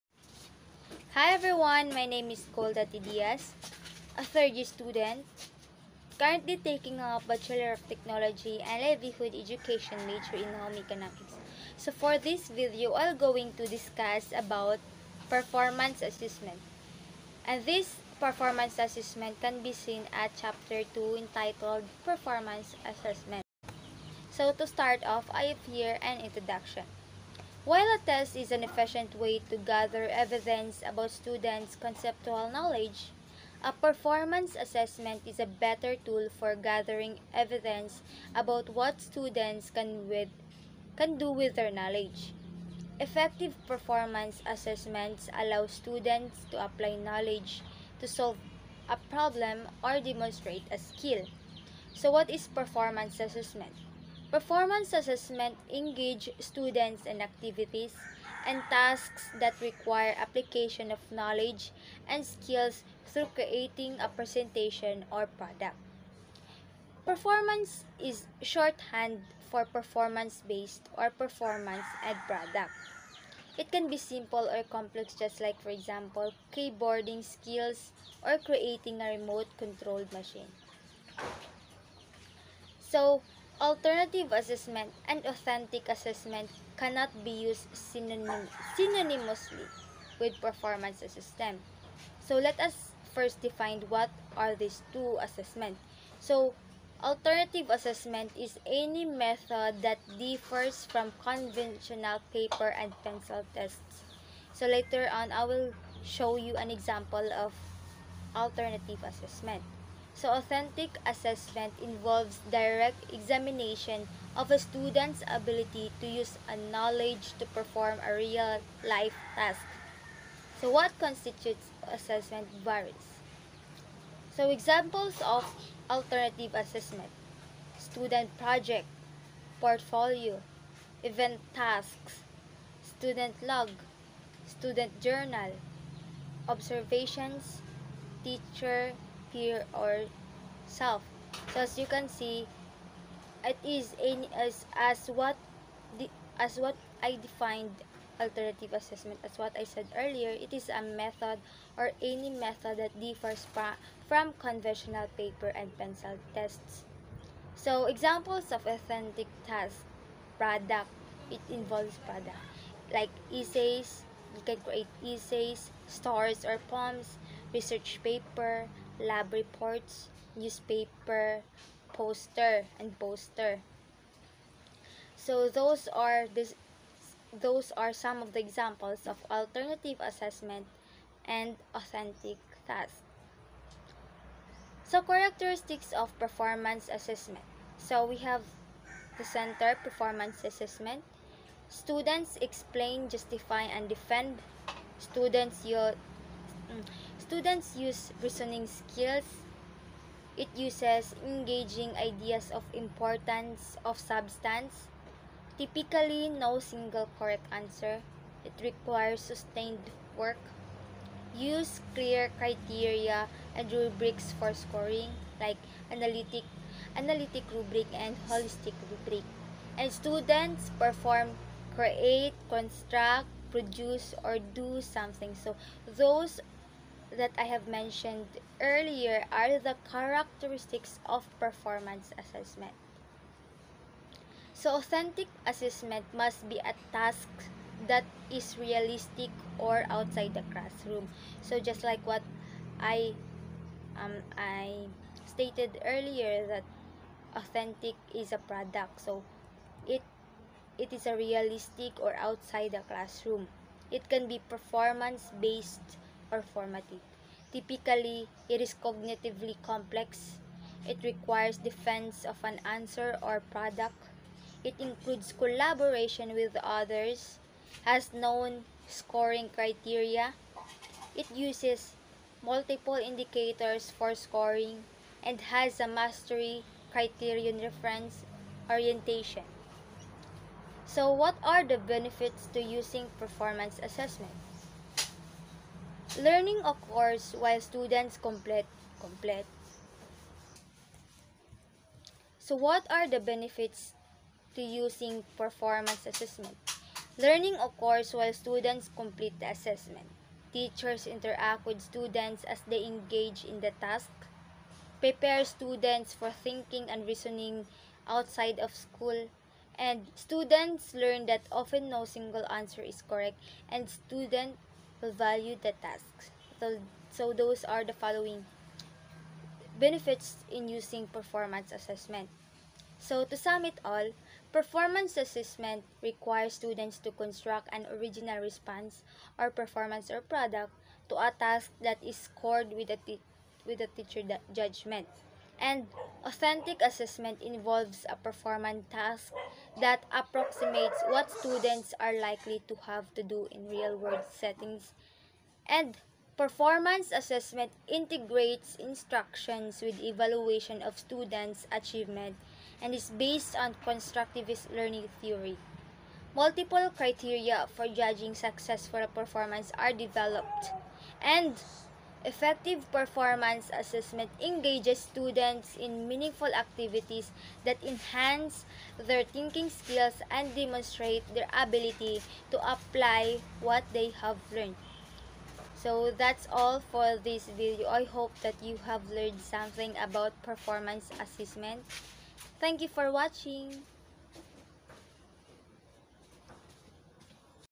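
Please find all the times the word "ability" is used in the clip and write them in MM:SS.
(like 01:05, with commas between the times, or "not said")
01:55, 06:11.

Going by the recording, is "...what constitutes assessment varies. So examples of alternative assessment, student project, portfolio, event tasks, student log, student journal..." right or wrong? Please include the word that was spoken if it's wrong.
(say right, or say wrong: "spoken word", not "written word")
right.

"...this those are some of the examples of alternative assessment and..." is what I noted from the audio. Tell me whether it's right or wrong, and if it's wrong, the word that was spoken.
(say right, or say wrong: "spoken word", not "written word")
right.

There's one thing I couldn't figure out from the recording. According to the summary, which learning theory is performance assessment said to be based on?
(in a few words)
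constructivist learning theory.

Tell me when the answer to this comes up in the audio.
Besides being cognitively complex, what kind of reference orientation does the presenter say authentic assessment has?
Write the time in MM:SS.
04:35.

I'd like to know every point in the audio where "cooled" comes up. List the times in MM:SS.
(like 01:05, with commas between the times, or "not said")
not said.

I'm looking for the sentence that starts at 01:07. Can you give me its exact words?
Performance is shorthand for performance-based or performance and product.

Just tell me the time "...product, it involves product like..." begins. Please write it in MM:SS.
02:40.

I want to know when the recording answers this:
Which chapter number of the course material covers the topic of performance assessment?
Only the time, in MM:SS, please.
00:20.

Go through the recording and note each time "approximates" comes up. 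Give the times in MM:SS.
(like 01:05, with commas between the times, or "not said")
05:40.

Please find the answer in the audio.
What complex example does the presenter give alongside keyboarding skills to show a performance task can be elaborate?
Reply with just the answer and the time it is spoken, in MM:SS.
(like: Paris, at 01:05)
remote controlled machine, at 01:19.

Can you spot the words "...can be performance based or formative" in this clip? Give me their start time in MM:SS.
04:14.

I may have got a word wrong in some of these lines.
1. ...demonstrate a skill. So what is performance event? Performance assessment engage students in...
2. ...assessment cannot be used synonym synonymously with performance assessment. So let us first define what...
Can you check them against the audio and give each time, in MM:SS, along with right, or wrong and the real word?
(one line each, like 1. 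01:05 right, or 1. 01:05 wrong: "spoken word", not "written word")
1. 00:49 wrong: "assessment", not "event"
2. 01:25 right.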